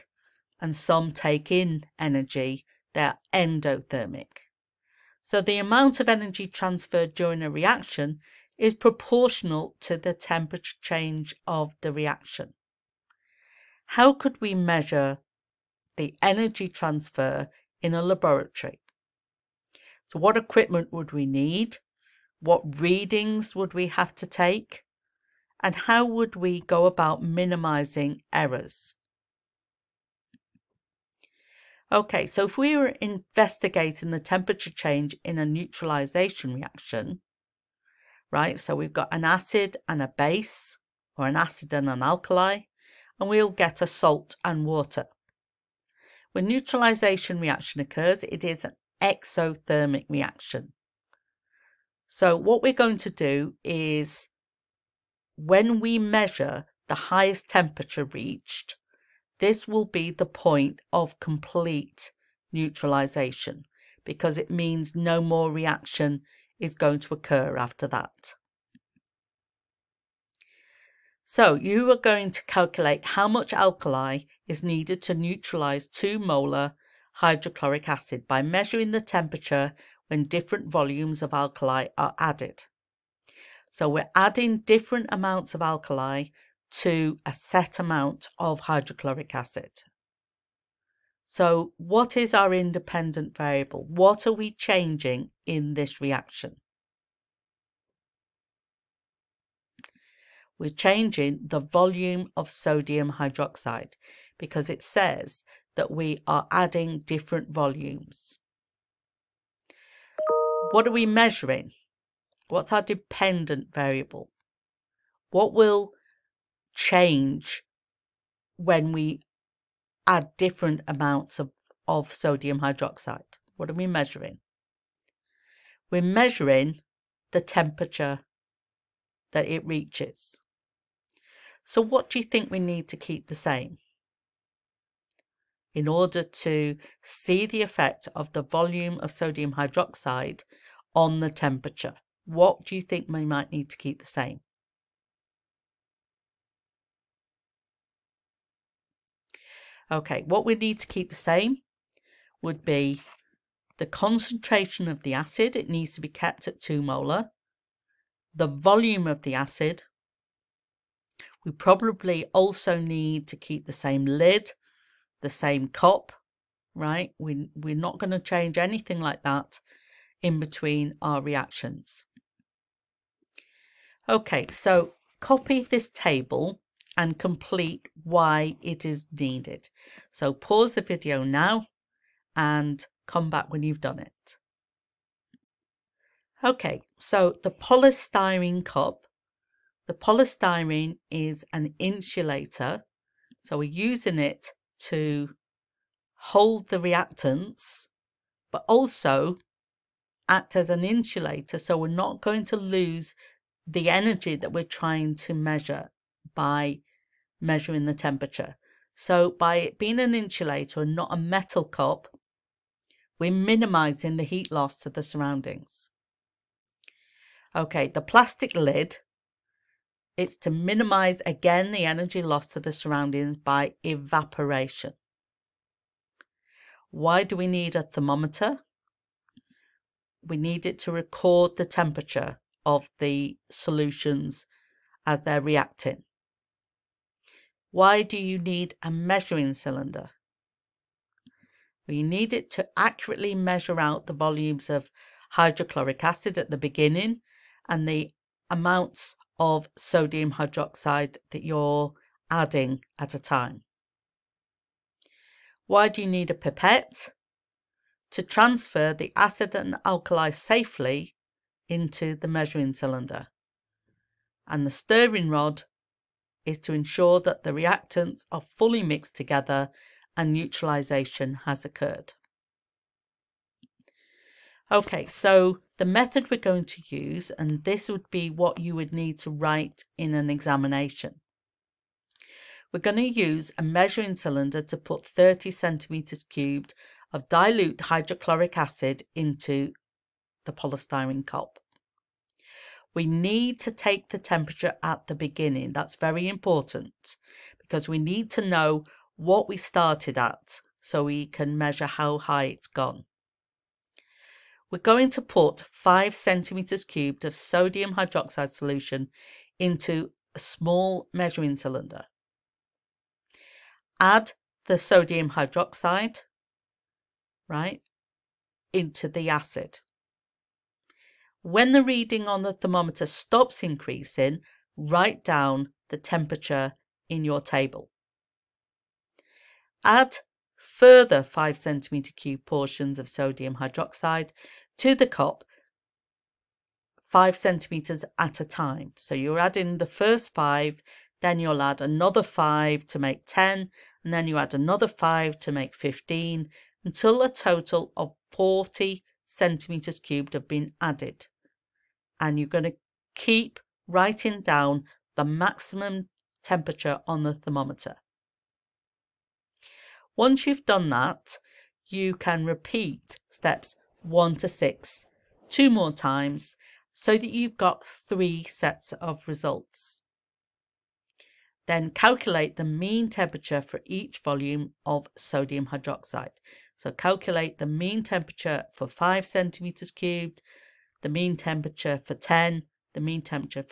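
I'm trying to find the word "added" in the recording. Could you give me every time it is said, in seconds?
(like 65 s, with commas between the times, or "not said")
82 s, 350 s.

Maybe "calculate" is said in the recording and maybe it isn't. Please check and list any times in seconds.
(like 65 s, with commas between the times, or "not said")
72 s, 371 s, 376 s.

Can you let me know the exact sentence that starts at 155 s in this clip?
It needs to be kept at 2 molar.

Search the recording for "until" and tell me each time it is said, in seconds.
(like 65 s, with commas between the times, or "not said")
346 s.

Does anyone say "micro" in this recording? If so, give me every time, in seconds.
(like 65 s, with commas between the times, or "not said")
not said.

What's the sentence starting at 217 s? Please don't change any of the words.
Okay, the plastic lid, it's to minimize again the energy loss to the surroundings by evaporation.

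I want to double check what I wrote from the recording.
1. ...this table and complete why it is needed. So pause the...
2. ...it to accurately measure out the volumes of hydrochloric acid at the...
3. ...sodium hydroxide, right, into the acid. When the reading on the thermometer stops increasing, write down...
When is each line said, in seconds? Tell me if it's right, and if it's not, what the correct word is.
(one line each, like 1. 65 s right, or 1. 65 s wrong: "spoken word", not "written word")
1. 175 s right
2. 242 s right
3. 314 s right.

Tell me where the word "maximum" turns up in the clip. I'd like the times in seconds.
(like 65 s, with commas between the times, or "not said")
355 s.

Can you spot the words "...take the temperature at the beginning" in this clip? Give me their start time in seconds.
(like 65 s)
293 s.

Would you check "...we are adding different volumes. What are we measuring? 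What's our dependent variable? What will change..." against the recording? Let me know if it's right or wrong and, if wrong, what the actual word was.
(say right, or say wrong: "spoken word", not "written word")
right.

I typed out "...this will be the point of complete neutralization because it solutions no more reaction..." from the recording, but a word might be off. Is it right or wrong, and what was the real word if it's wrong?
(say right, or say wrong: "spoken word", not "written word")
wrong: "means", not "solutions".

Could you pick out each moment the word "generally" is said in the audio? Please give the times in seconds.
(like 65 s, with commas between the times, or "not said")
not said.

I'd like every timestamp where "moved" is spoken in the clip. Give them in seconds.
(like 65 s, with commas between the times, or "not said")
not said.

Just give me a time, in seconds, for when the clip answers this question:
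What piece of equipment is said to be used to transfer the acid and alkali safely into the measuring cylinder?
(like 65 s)
256 s.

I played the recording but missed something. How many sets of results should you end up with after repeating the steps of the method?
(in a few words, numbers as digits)
3.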